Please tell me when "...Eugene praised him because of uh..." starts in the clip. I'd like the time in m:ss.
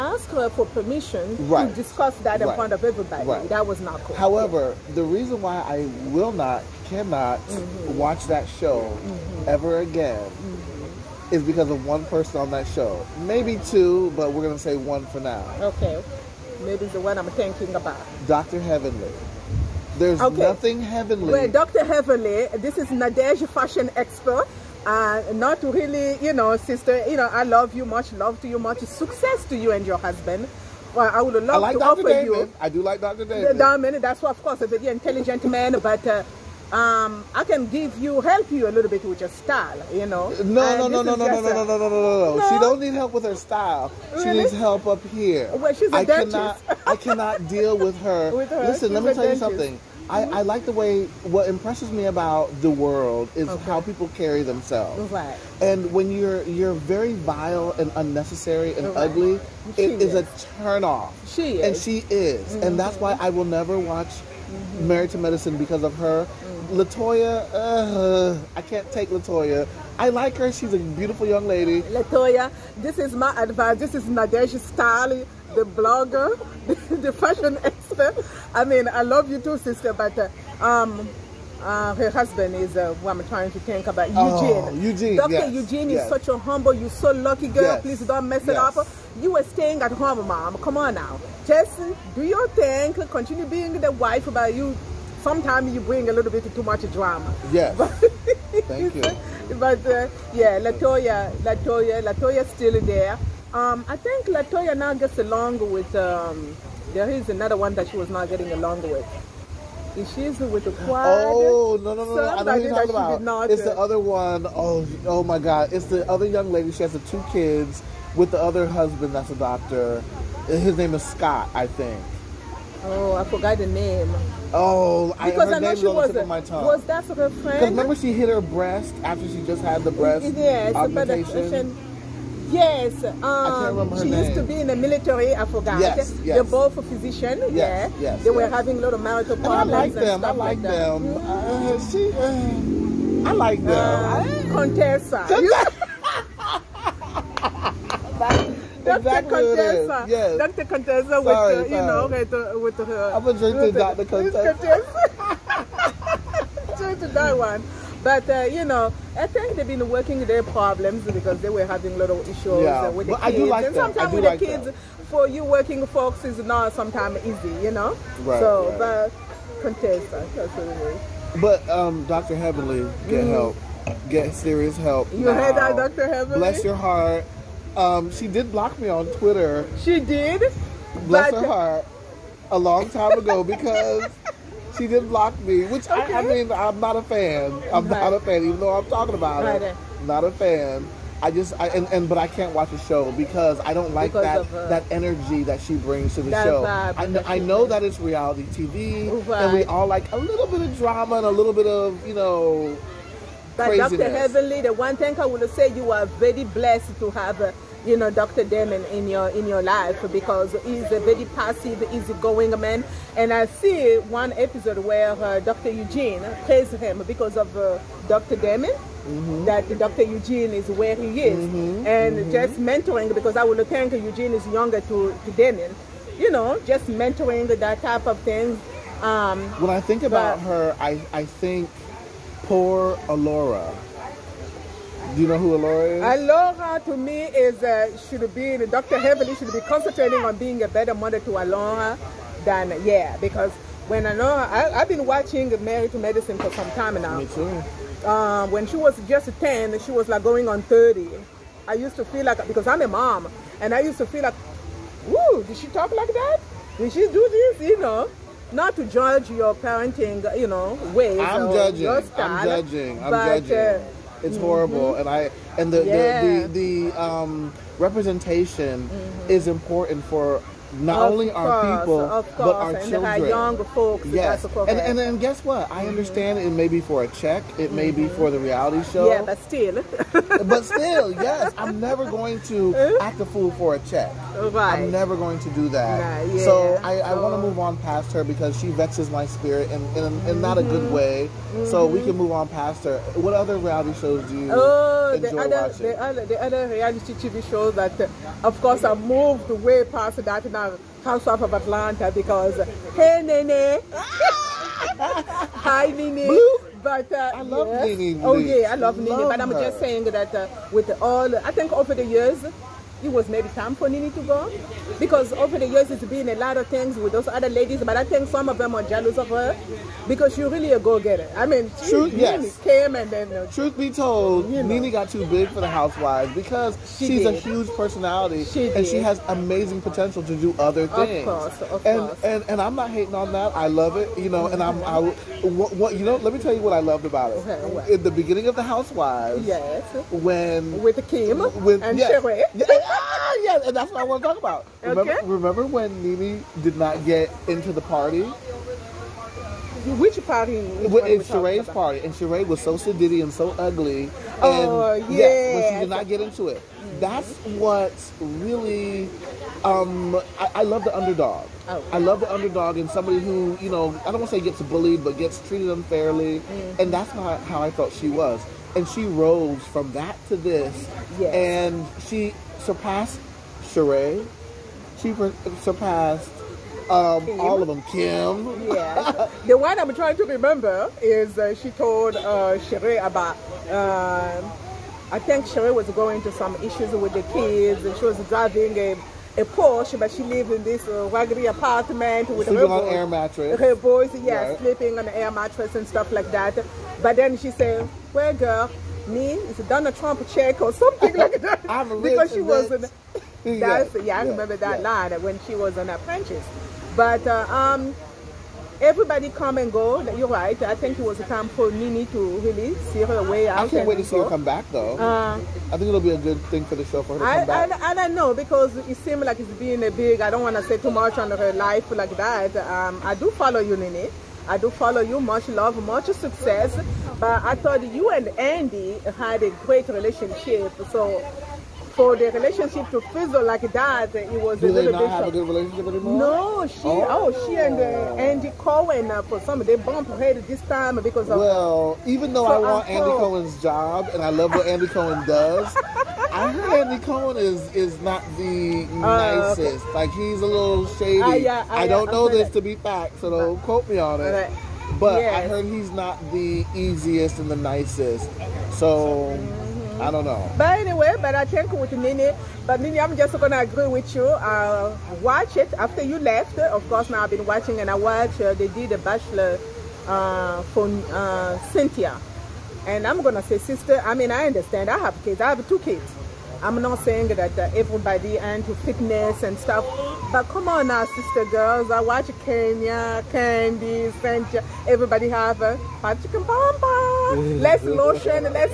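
3:35.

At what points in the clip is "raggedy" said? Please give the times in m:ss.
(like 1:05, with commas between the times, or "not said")
6:31.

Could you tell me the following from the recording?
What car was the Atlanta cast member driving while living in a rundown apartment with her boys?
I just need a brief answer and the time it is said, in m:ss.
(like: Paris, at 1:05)
Porsche, at 6:29.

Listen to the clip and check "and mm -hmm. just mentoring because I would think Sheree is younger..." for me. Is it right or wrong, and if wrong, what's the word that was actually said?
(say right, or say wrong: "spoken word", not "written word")
wrong: "Eugene", not "Sheree".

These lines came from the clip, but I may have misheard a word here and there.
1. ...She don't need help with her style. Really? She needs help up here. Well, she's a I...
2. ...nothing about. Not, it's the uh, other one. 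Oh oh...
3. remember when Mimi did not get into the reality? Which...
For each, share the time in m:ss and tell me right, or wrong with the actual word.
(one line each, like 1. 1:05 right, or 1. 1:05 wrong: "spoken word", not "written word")
1. 0:42 right
2. 1:52 wrong: "talking", not "nothing"
3. 5:45 wrong: "party", not "reality".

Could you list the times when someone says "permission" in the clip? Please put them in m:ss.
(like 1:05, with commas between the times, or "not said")
0:00.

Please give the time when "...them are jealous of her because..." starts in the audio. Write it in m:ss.
5:18.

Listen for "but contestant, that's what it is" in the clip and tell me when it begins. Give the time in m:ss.
2:48.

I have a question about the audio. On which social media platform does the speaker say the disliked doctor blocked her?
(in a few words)
Twitter.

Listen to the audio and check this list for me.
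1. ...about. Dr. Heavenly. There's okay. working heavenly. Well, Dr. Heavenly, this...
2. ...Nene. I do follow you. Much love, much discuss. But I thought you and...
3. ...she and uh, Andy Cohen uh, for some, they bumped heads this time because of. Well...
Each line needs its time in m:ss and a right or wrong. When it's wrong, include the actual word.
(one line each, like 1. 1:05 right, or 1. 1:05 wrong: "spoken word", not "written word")
1. 0:17 wrong: "nothing", not "working"
2. 7:03 wrong: "success", not "discuss"
3. 7:17 right.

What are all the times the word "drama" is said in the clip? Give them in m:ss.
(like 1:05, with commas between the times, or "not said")
1:36, 3:20.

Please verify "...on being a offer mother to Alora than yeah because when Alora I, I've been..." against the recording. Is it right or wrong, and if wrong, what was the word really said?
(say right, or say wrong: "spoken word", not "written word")
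wrong: "better", not "offer".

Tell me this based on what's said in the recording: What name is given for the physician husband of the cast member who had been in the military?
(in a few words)
Scott.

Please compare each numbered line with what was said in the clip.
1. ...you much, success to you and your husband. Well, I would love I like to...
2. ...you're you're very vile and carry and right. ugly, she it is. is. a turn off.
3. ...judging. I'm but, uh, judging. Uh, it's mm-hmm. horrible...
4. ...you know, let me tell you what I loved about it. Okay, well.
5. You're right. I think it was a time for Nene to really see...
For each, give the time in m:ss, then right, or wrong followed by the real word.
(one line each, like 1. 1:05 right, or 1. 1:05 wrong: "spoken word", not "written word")
1. 0:28 right
2. 0:56 wrong: "unnecessary", not "carry"
3. 4:22 right
4. 5:35 right
5. 6:50 right.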